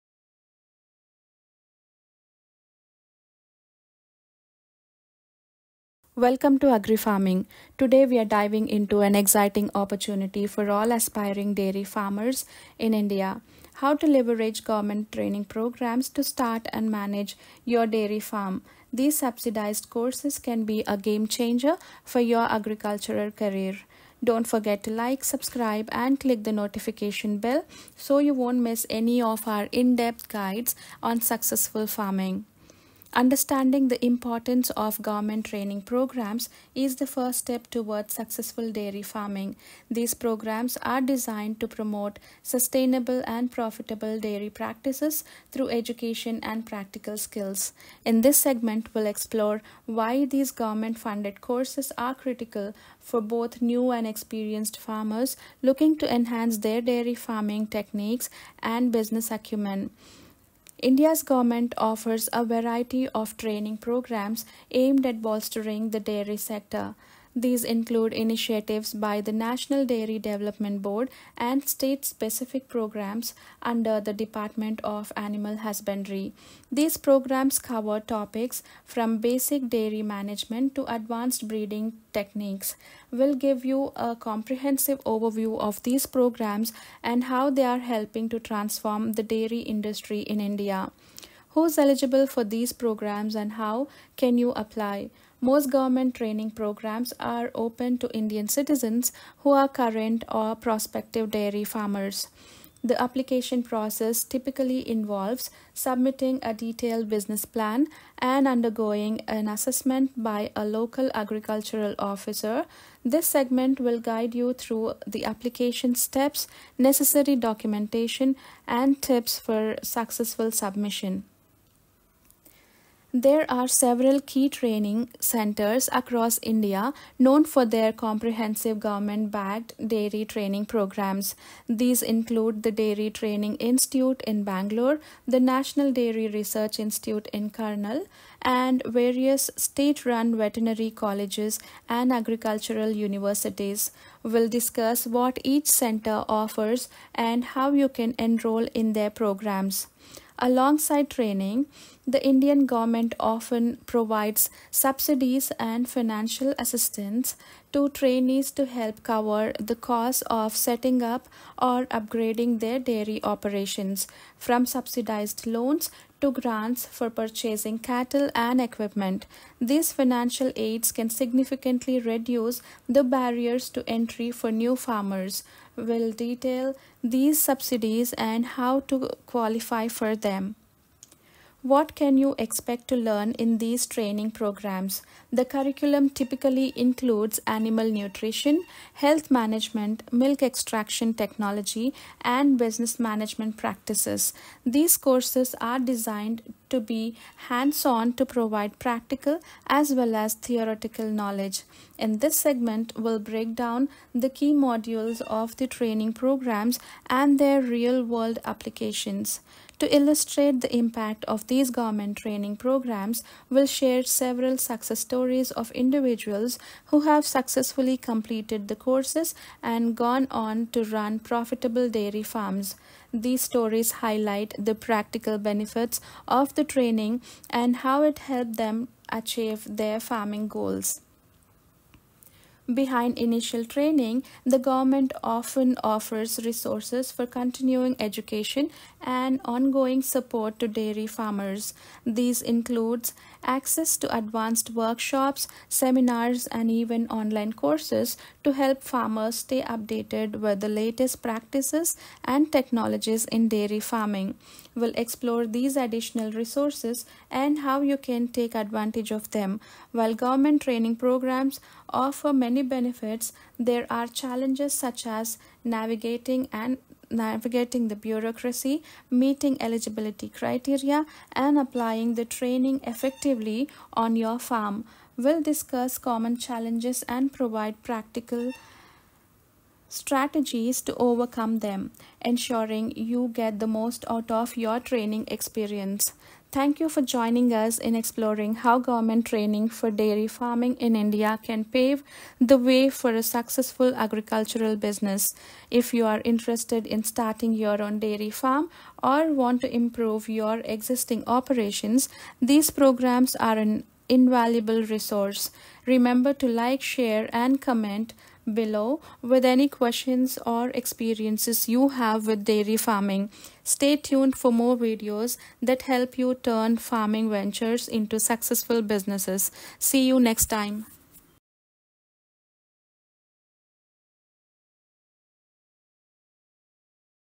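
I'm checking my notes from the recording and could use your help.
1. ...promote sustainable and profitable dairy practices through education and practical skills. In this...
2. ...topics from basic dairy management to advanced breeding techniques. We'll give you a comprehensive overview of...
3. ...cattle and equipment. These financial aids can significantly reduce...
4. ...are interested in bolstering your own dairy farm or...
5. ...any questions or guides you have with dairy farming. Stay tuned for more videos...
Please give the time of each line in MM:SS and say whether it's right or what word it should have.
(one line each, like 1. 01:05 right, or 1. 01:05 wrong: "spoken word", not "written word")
1. 00:41 right
2. 01:18 right
3. 02:47 right
4. 04:56 wrong: "starting", not "bolstering"
5. 05:09 wrong: "experiences", not "guides".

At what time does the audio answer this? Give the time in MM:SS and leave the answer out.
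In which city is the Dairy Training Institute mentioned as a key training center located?
02:14.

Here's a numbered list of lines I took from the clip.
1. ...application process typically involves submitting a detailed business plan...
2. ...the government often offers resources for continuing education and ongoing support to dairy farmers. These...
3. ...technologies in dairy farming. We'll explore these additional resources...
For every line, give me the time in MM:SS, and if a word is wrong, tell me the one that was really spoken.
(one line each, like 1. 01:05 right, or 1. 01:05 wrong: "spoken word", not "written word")
1. 01:43 right
2. 03:54 right
3. 04:12 right.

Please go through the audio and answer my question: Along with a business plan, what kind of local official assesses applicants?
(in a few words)
Agricultural officer.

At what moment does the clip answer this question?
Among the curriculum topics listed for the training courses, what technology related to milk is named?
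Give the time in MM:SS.
03:10.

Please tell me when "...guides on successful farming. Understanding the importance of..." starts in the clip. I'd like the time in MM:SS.
00:30.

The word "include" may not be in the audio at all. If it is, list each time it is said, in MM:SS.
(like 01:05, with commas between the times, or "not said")
01:07, 02:12, 03:06, 04:02.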